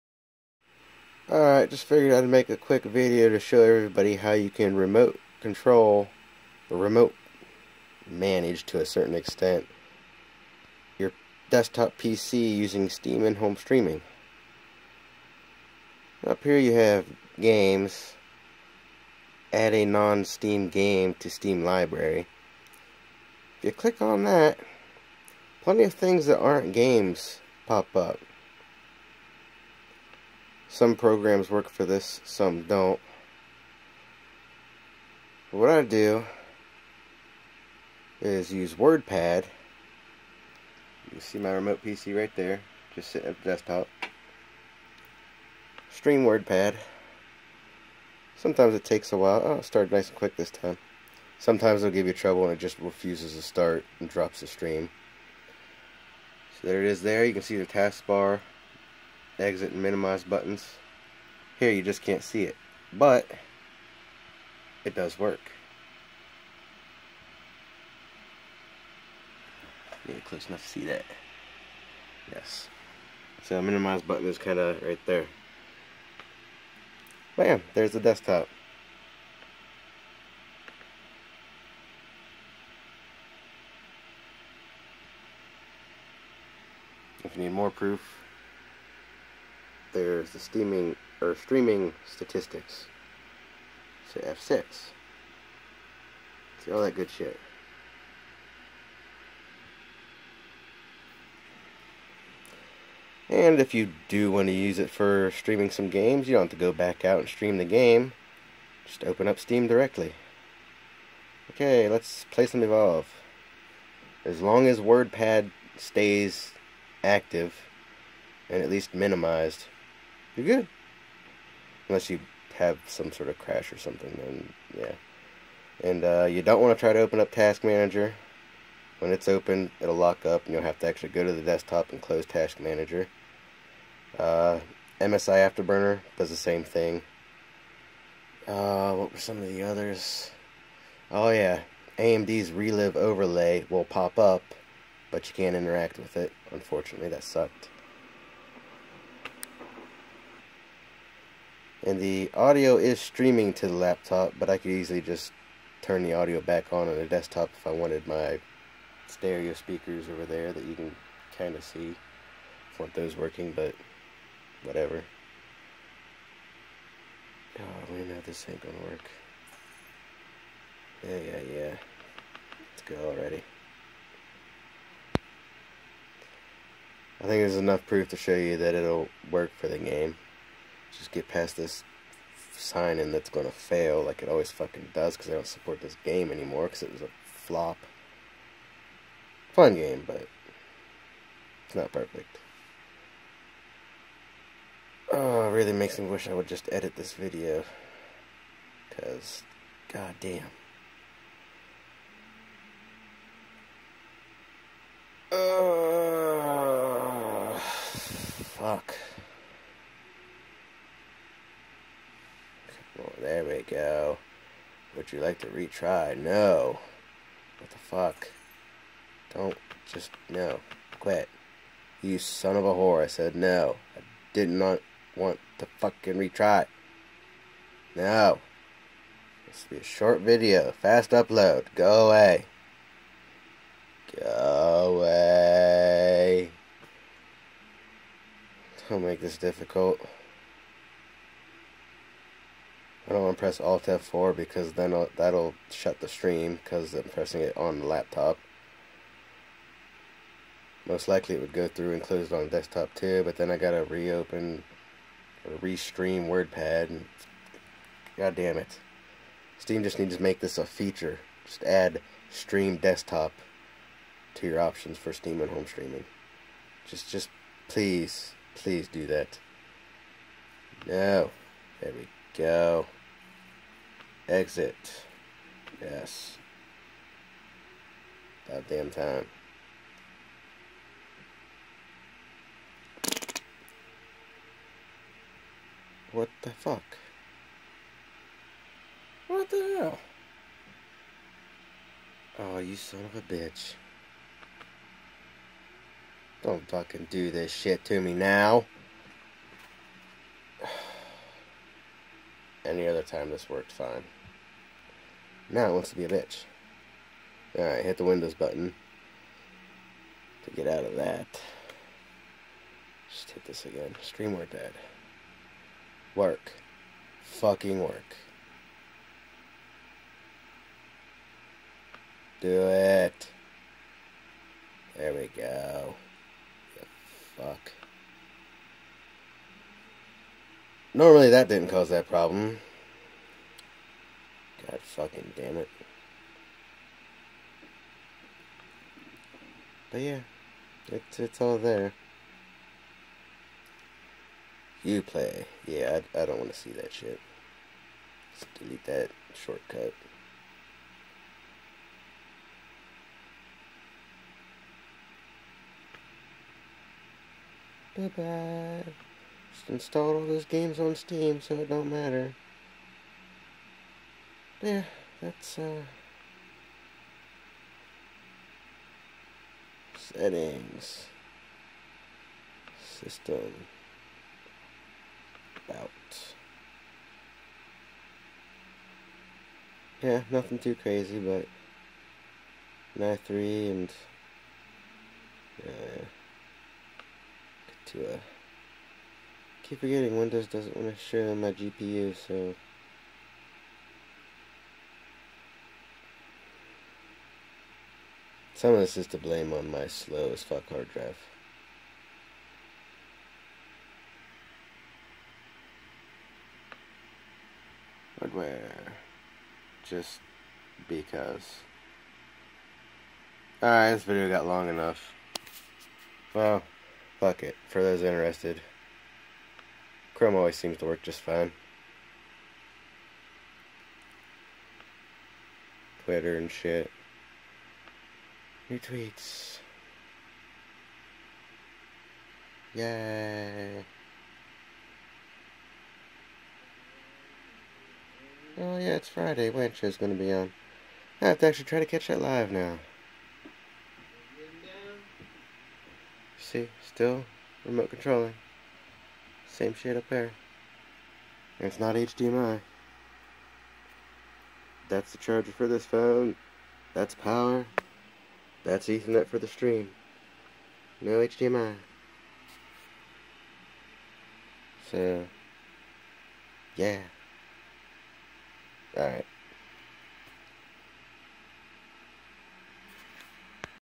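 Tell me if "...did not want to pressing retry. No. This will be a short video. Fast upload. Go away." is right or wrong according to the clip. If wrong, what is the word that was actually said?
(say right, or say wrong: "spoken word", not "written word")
wrong: "fucking", not "pressing".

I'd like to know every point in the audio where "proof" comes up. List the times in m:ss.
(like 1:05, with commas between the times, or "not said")
1:27, 2:57.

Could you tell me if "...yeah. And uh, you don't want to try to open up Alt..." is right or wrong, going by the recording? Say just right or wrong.
wrong.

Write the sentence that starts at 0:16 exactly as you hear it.
Up here you have games, add a non-Steam game to Steam library.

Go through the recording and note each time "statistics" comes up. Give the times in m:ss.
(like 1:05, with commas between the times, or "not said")
1:32.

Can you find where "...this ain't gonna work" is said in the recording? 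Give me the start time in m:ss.
2:48.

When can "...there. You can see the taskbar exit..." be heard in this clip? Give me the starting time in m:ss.
0:57.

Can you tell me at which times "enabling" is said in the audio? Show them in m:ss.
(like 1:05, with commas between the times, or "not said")
not said.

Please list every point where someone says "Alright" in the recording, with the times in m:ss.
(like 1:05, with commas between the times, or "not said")
0:01, 5:07, 6:53, 7:48.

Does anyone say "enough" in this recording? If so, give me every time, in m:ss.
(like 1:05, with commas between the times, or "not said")
1:10, 2:57, 6:54.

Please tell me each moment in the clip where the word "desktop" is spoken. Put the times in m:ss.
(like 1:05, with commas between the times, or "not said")
0:11, 0:43, 1:17, 2:11, 2:37, 4:12, 4:22.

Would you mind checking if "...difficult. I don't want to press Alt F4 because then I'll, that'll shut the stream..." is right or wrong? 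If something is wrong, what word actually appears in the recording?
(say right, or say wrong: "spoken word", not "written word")
right.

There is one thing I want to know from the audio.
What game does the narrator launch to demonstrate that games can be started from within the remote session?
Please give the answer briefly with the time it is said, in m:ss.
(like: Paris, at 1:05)
Evolve, at 1:52.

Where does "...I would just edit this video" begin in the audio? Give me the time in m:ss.
3:16.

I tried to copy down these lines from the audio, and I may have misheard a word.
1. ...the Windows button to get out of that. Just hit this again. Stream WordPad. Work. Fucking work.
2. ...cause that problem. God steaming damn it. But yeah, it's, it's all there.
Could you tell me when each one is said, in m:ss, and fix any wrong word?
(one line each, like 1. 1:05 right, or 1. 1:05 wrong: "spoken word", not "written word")
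1. 5:07 right
2. 5:31 wrong: "fucking", not "steaming".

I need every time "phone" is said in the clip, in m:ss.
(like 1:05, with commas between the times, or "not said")
7:35.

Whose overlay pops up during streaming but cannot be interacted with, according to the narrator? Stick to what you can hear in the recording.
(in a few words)
AMD's ReLive.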